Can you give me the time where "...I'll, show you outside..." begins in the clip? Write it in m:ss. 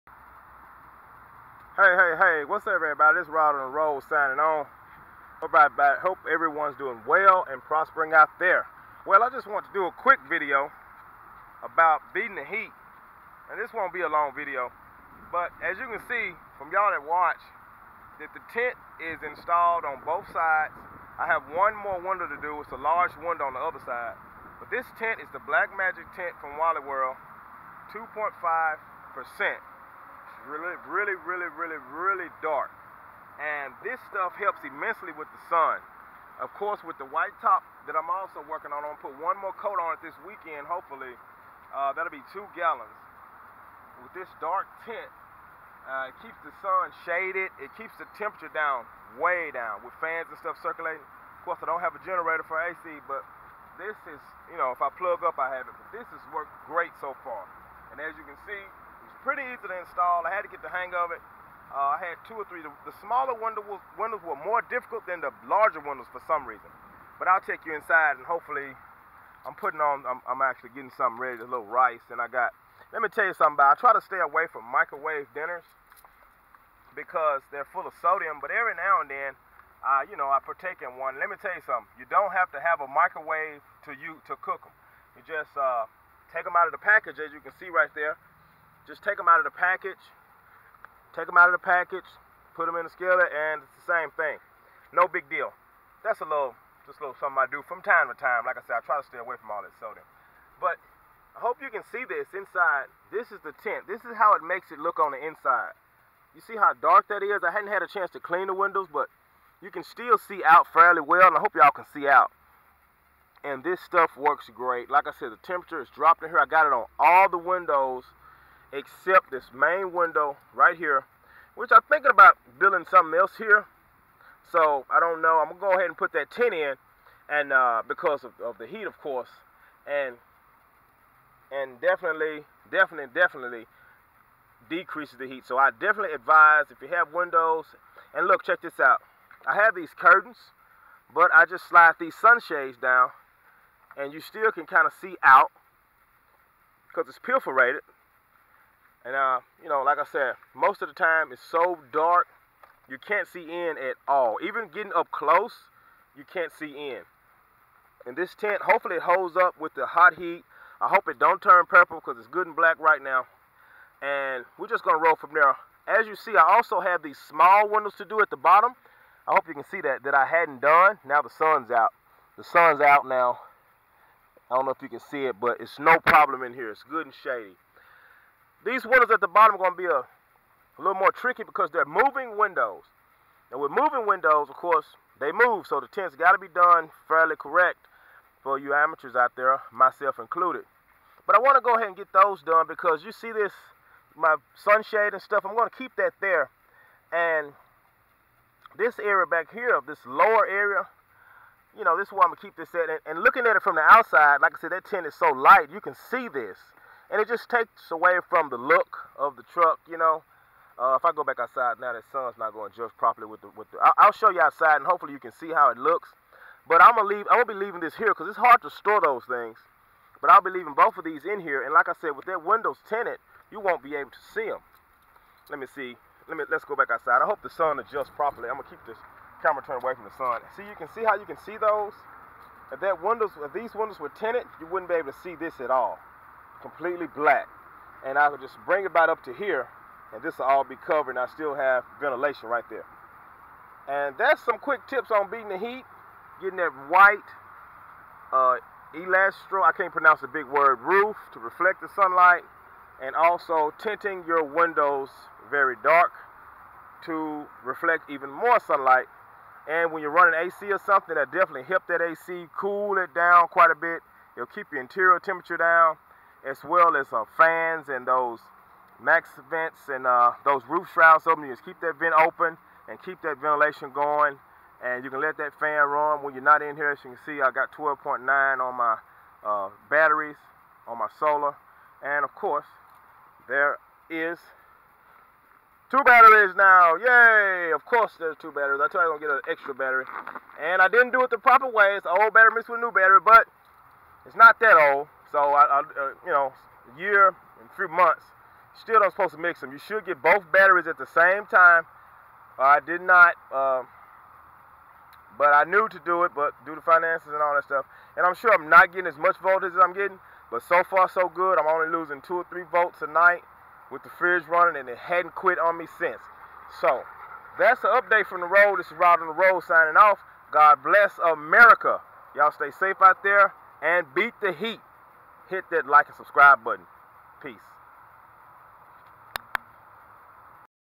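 3:33.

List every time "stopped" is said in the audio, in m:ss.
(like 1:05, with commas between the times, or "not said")
not said.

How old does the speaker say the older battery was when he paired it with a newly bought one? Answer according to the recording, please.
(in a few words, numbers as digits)
a year and a few months.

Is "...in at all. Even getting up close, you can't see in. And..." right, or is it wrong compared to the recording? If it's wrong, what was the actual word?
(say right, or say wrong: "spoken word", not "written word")
right.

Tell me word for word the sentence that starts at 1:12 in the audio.
And I got, let me tell you something about, I try to stay away from microwave dinners because they're full of sodium.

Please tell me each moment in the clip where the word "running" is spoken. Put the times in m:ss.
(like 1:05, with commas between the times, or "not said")
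4:20, 5:14.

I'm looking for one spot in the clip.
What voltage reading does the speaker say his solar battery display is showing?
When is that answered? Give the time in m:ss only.
4:37.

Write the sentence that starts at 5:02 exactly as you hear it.
I did not, uh, but I knew to do it, but due to finances and all that stuff.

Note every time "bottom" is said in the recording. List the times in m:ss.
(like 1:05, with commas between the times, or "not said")
2:48, 2:59.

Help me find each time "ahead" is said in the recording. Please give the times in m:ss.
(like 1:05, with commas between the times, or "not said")
2:05, 3:11.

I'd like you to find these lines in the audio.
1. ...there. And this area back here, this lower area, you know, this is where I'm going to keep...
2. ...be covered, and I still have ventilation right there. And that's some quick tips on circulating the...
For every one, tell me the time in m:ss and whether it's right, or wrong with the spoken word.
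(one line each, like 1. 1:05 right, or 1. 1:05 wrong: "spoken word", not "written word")
1. 3:16 right
2. 4:00 wrong: "beating", not "circulating".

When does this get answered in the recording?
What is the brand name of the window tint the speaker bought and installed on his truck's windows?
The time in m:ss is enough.
0:25.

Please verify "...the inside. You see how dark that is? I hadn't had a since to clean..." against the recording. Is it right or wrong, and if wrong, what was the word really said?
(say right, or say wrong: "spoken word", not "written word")
wrong: "chance", not "since".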